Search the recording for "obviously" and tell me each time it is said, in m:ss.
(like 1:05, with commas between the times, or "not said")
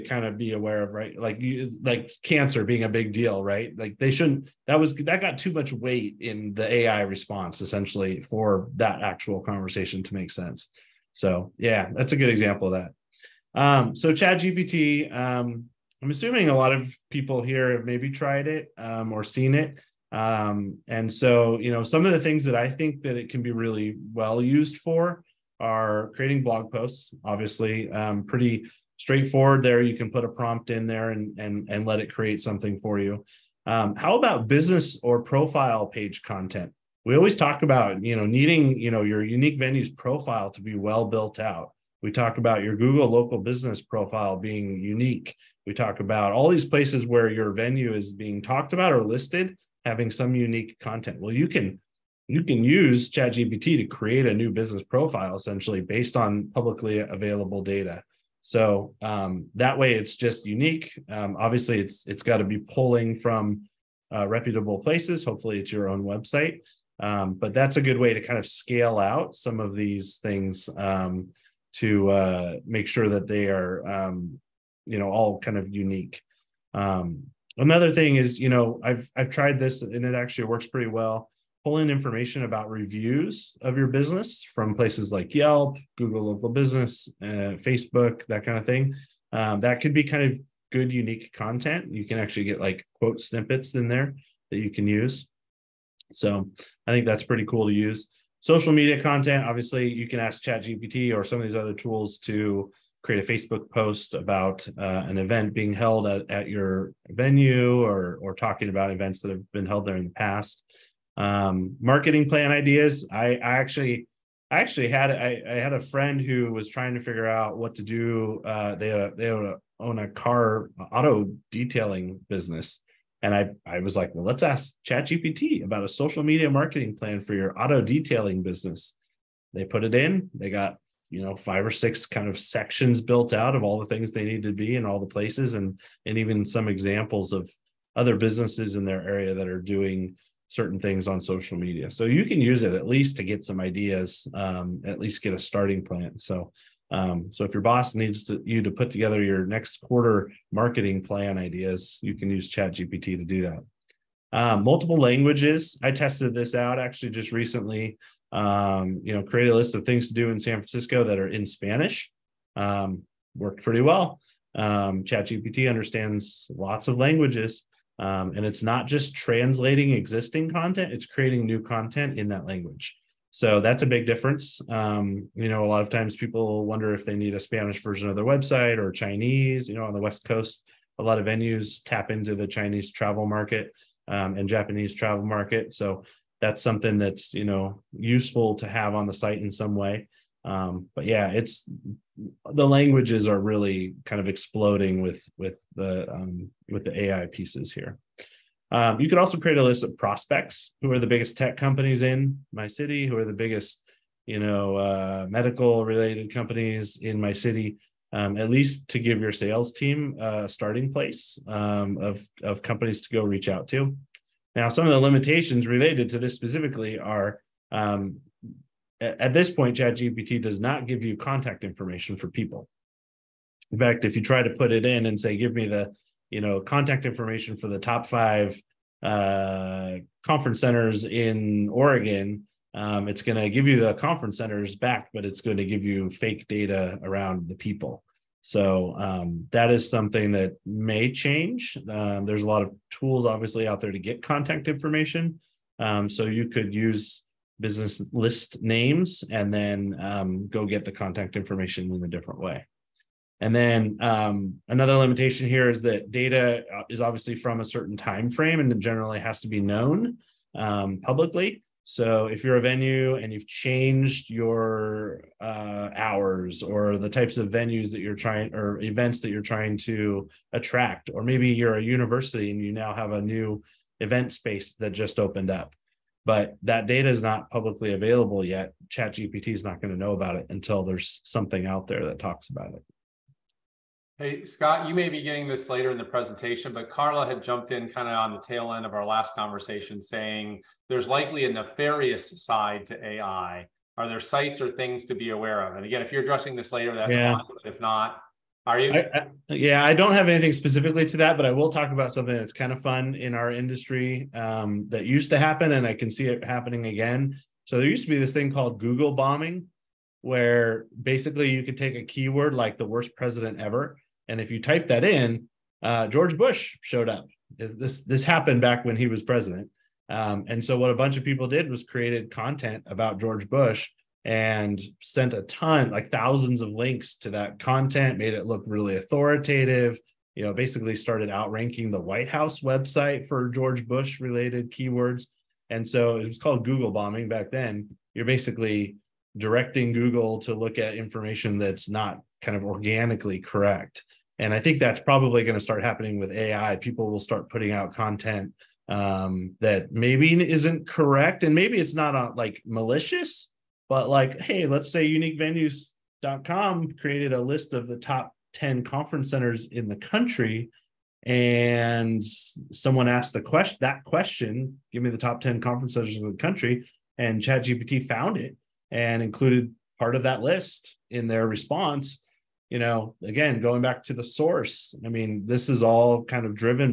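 0:27, 1:01, 1:39, 4:03, 4:17.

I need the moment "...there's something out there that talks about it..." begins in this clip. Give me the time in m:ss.
4:40.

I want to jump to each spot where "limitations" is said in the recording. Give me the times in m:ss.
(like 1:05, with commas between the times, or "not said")
3:34, 4:14.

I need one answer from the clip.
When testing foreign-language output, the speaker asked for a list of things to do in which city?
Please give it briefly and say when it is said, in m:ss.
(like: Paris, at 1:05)
San Francisco, at 2:40.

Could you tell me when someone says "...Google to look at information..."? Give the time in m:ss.
5:39.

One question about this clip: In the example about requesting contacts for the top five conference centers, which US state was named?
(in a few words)
Oregon.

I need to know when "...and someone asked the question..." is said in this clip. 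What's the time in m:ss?
6:01.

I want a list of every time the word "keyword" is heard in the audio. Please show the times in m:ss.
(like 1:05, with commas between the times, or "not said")
5:12, 5:34.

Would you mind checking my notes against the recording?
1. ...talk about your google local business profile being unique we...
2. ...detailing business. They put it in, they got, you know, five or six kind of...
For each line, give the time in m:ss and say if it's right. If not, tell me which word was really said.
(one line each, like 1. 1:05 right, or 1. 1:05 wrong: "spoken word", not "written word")
1. 0:42 right
2. 2:07 right.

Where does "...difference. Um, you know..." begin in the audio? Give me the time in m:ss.
2:54.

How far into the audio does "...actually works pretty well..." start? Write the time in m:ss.
1:20.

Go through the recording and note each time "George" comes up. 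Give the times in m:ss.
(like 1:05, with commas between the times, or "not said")
5:16, 5:23, 5:33.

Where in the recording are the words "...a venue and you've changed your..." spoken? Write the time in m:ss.
4:22.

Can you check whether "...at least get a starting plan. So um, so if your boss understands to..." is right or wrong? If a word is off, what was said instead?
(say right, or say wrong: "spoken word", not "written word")
wrong: "needs", not "understands".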